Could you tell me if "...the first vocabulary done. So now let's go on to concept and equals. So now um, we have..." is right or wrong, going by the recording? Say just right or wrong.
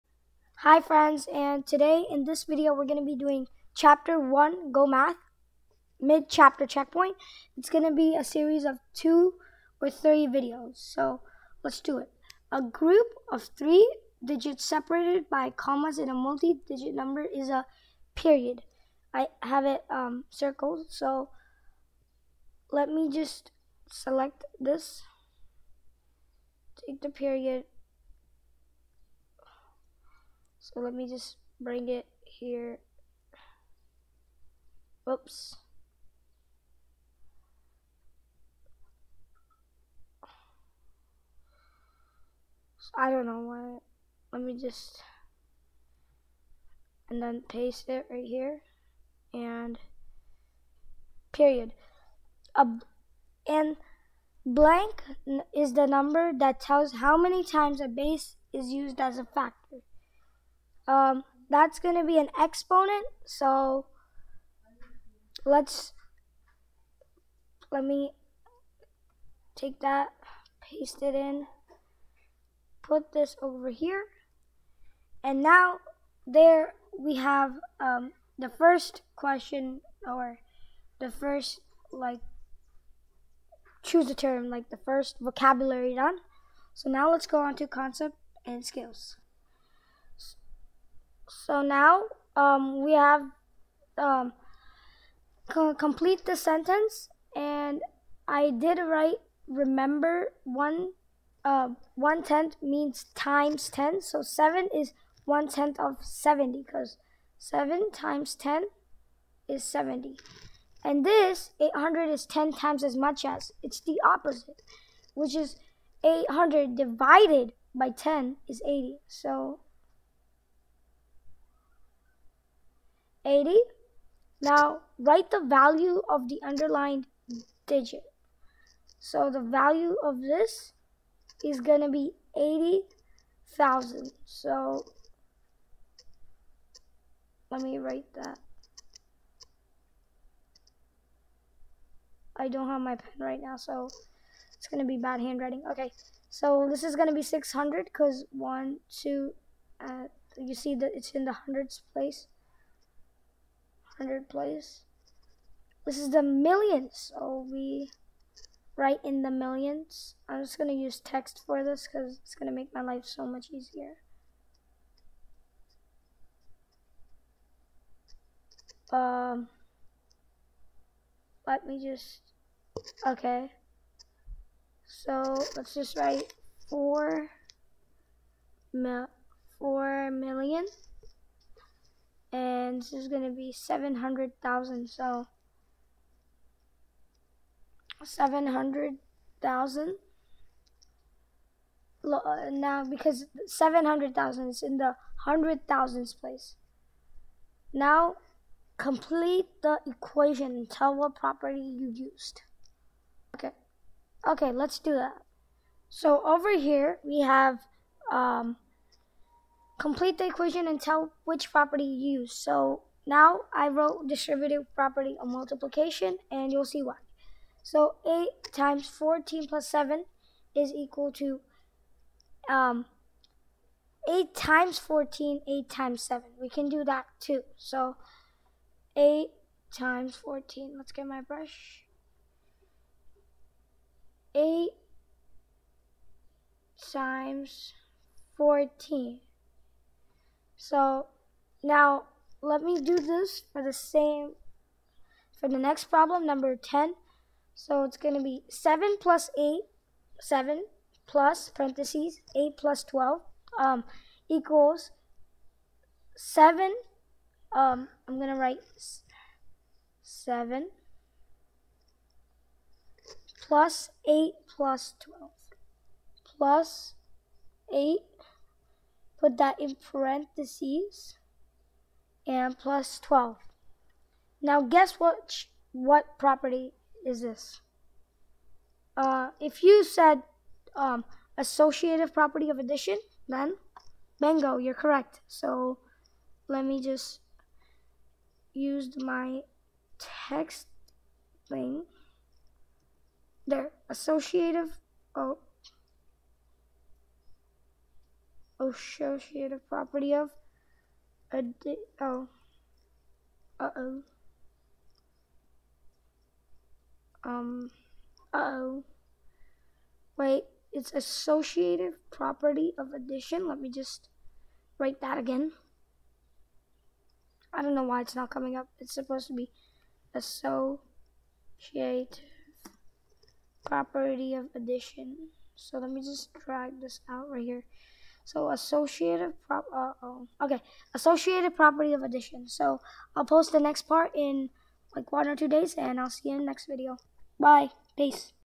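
wrong.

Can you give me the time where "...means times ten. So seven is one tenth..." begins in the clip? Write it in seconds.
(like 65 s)
102 s.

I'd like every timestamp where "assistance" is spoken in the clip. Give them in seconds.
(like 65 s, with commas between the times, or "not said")
not said.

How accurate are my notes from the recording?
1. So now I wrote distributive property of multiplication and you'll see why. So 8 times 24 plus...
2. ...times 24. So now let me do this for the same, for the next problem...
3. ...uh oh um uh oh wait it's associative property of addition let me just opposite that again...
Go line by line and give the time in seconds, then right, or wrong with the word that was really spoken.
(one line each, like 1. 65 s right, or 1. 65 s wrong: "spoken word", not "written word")
1. 212 s wrong: "14", not "24"
2. 236 s wrong: "14", not "24"
3. 303 s wrong: "write", not "opposite".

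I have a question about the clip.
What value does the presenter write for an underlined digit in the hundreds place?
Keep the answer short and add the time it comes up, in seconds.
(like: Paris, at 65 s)
600, at 146 s.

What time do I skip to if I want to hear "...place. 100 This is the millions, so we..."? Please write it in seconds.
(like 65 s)
151 s.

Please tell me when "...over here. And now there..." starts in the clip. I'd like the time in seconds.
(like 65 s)
73 s.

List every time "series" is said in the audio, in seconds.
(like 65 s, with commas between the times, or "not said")
8 s.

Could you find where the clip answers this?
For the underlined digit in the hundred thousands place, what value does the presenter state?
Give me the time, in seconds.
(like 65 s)
182 s.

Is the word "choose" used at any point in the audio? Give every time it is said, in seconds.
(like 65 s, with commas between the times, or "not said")
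83 s.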